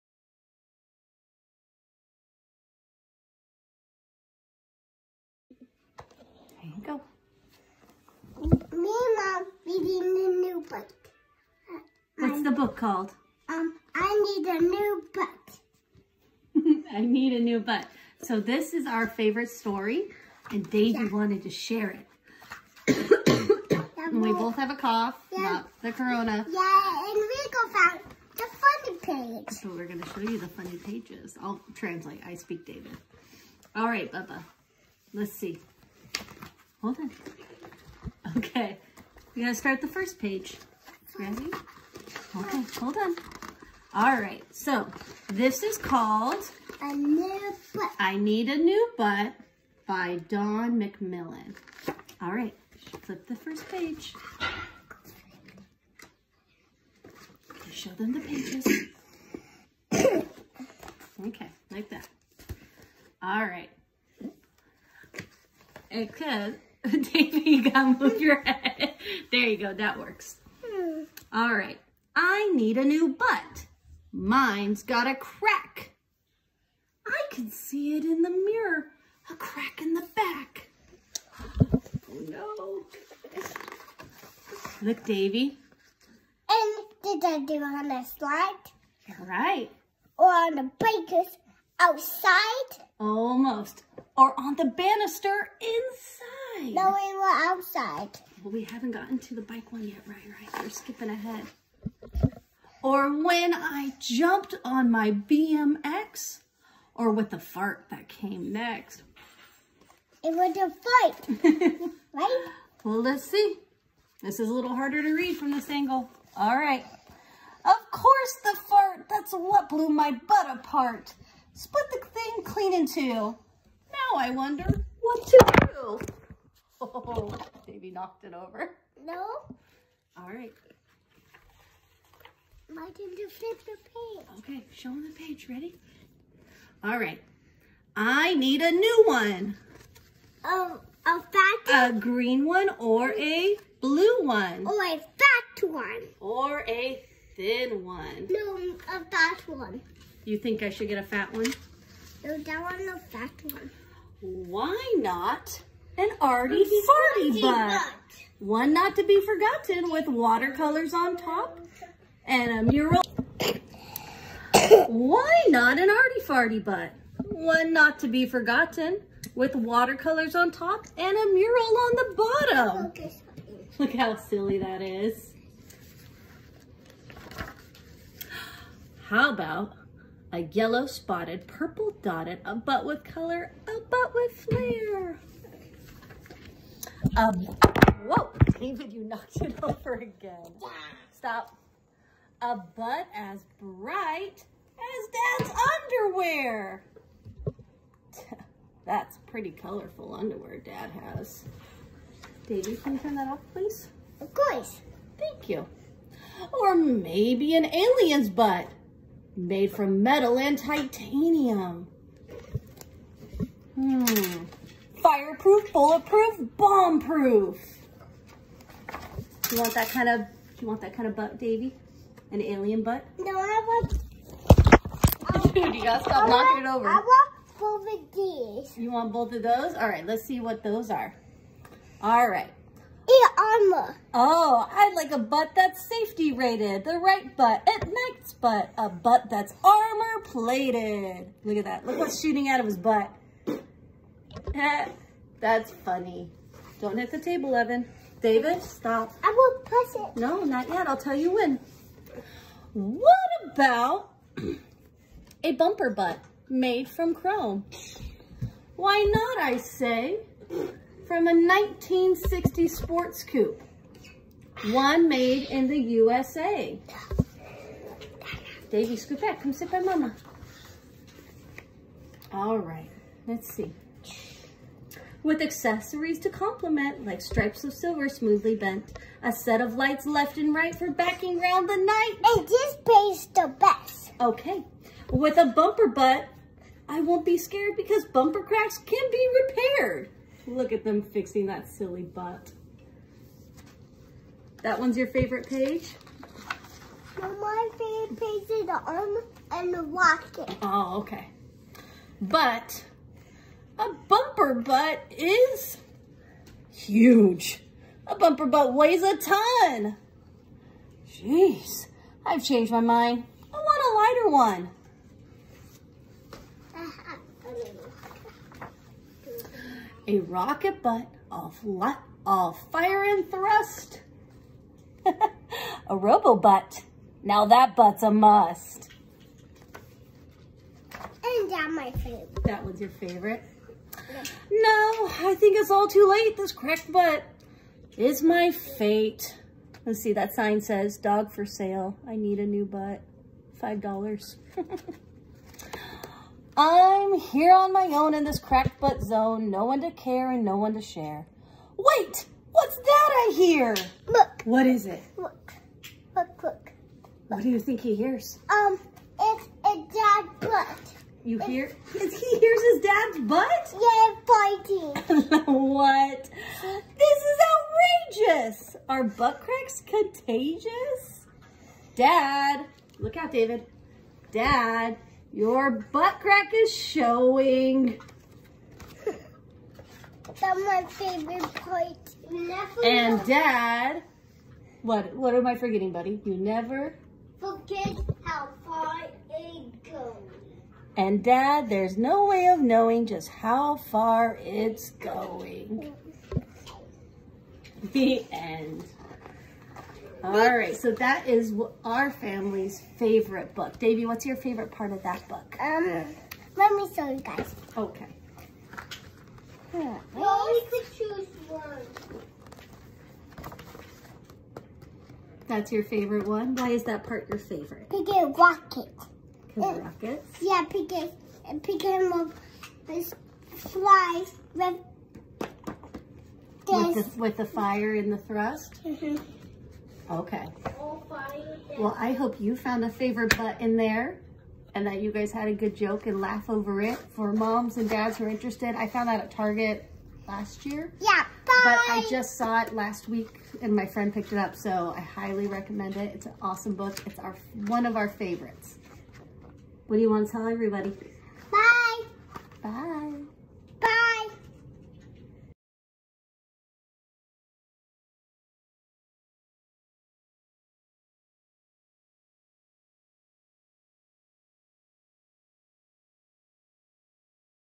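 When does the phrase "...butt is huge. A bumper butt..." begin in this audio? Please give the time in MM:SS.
05:04.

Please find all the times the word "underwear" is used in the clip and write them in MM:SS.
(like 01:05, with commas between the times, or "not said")
03:16, 03:20.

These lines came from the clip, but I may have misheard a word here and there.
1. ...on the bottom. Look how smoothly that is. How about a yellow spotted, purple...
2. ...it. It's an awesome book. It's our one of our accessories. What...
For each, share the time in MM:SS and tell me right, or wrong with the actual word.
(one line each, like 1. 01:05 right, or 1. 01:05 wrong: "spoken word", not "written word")
1. 02:51 wrong: "silly", not "smoothly"
2. 07:25 wrong: "favorites", not "accessories".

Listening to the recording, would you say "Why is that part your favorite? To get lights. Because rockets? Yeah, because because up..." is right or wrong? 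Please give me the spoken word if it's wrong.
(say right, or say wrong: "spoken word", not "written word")
wrong: "rockets", not "lights".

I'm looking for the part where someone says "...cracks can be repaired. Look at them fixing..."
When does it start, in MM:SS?
04:48.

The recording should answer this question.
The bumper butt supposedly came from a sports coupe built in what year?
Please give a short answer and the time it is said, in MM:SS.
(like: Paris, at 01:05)
1960, at 04:21.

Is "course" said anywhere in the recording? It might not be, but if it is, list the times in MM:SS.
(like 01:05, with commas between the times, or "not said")
01:57, 03:24.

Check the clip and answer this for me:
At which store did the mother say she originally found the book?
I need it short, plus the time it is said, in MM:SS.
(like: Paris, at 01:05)
Target, at 07:19.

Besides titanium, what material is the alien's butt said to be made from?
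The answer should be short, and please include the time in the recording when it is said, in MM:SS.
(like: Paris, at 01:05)
Metal, at 03:30.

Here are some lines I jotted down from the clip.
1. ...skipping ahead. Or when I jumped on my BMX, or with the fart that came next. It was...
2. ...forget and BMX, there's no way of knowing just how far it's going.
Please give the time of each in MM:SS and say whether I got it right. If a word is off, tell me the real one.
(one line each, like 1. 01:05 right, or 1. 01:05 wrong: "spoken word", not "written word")
1. 01:40 right
2. 06:27 wrong: "Dad", not "BMX".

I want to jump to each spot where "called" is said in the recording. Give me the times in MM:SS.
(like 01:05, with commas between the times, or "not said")
00:12, 00:45.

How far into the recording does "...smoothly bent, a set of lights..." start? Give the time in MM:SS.
04:38.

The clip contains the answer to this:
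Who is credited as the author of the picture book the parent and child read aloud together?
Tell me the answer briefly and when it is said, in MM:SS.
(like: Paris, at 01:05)
Dawn McMillian, at 00:50.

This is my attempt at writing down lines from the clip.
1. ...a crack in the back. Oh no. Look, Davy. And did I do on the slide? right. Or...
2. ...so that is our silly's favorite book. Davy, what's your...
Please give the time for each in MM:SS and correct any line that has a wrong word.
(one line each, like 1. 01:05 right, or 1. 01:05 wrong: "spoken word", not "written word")
1. 01:19 right
2. 06:40 wrong: "family", not "silly".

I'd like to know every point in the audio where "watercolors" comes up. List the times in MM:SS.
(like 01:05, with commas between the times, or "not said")
02:40, 02:49.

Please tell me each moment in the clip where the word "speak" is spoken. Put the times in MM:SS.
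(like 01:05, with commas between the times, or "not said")
00:32.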